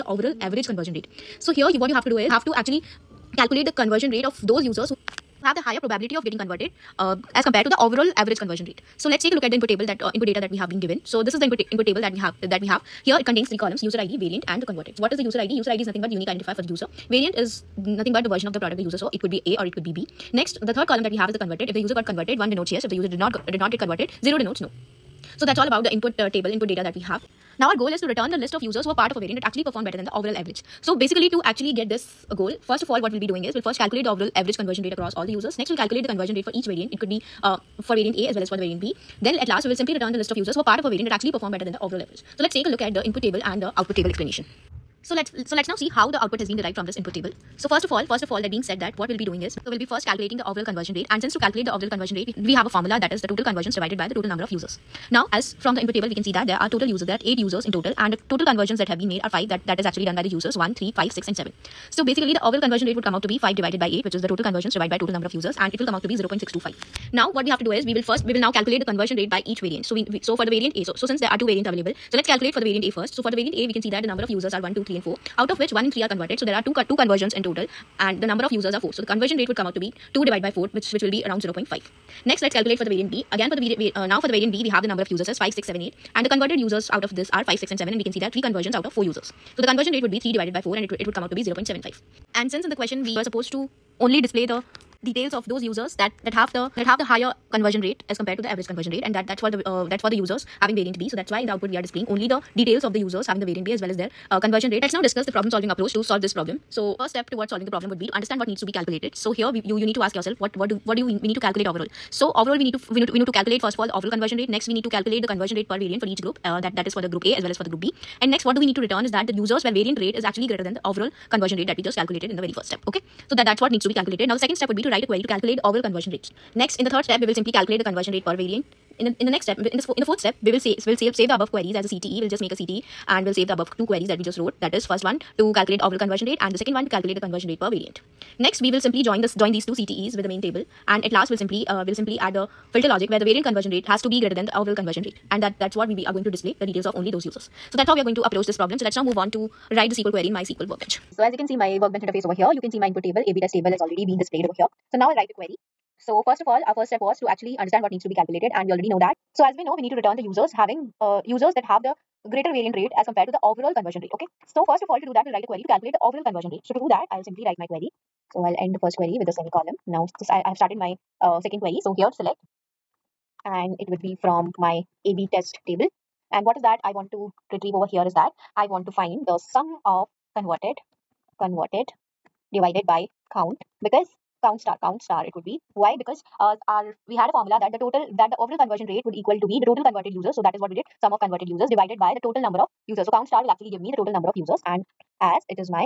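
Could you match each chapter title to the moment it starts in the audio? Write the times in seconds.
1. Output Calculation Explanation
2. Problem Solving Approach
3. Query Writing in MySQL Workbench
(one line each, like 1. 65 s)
1. 45 s
2. 105 s
3. 157 s.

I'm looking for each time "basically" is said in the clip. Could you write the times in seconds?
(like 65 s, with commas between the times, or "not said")
30 s, 62 s.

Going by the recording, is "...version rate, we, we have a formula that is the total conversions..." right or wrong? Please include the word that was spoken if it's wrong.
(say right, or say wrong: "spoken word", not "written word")
wrong: "conversion", not "version".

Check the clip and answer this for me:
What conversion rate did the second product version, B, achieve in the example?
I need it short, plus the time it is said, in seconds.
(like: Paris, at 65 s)
0.75, at 91 s.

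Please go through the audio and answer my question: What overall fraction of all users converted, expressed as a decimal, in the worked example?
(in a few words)
0.625.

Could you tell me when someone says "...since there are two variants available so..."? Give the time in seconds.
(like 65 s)
71 s.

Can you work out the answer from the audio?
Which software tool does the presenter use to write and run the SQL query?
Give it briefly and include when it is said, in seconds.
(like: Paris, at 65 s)
MySQL Workbench, at 150 s.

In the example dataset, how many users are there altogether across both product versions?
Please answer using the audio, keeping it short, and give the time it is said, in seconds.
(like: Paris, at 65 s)
8, at 57 s.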